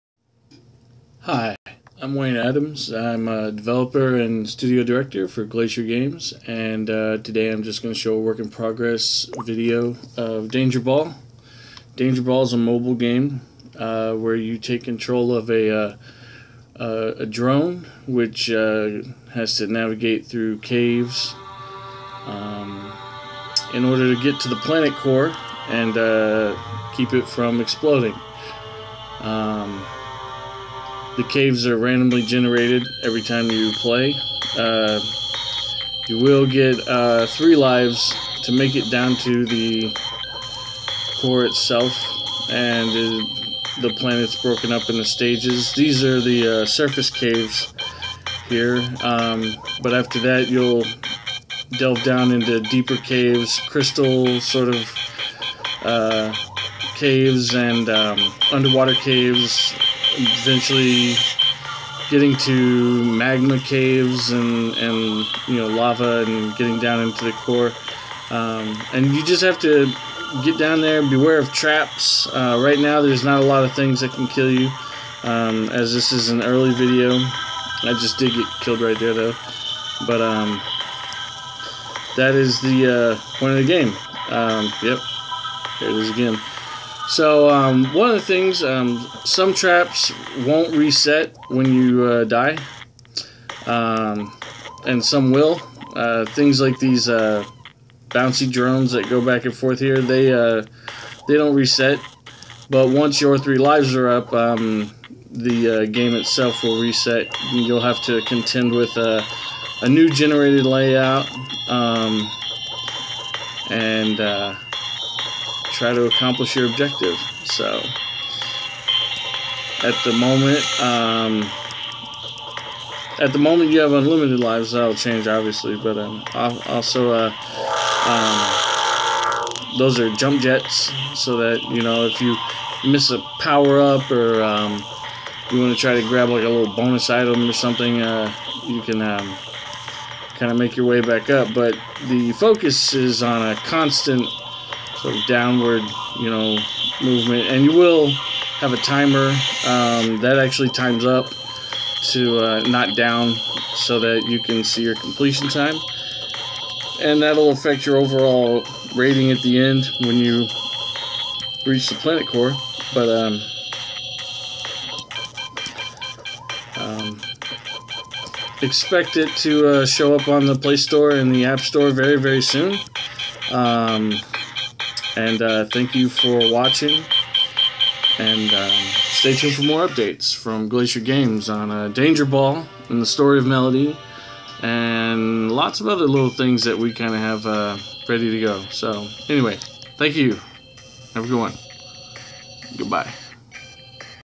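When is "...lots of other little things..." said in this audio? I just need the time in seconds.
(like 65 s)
185 s.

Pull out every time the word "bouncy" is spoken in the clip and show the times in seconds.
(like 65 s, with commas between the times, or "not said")
98 s.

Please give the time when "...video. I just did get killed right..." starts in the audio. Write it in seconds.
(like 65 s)
76 s.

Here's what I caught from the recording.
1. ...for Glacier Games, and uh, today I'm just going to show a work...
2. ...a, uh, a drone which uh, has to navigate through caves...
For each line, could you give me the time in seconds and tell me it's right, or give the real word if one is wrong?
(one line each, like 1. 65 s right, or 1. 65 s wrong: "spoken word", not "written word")
1. 5 s right
2. 15 s right.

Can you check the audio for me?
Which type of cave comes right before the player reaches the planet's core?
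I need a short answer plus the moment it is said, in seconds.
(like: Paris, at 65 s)
Magma caves, at 63 s.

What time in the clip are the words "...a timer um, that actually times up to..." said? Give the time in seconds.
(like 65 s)
148 s.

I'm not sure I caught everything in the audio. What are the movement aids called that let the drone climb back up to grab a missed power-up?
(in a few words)
Jump jets.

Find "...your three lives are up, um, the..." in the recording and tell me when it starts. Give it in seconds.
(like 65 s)
103 s.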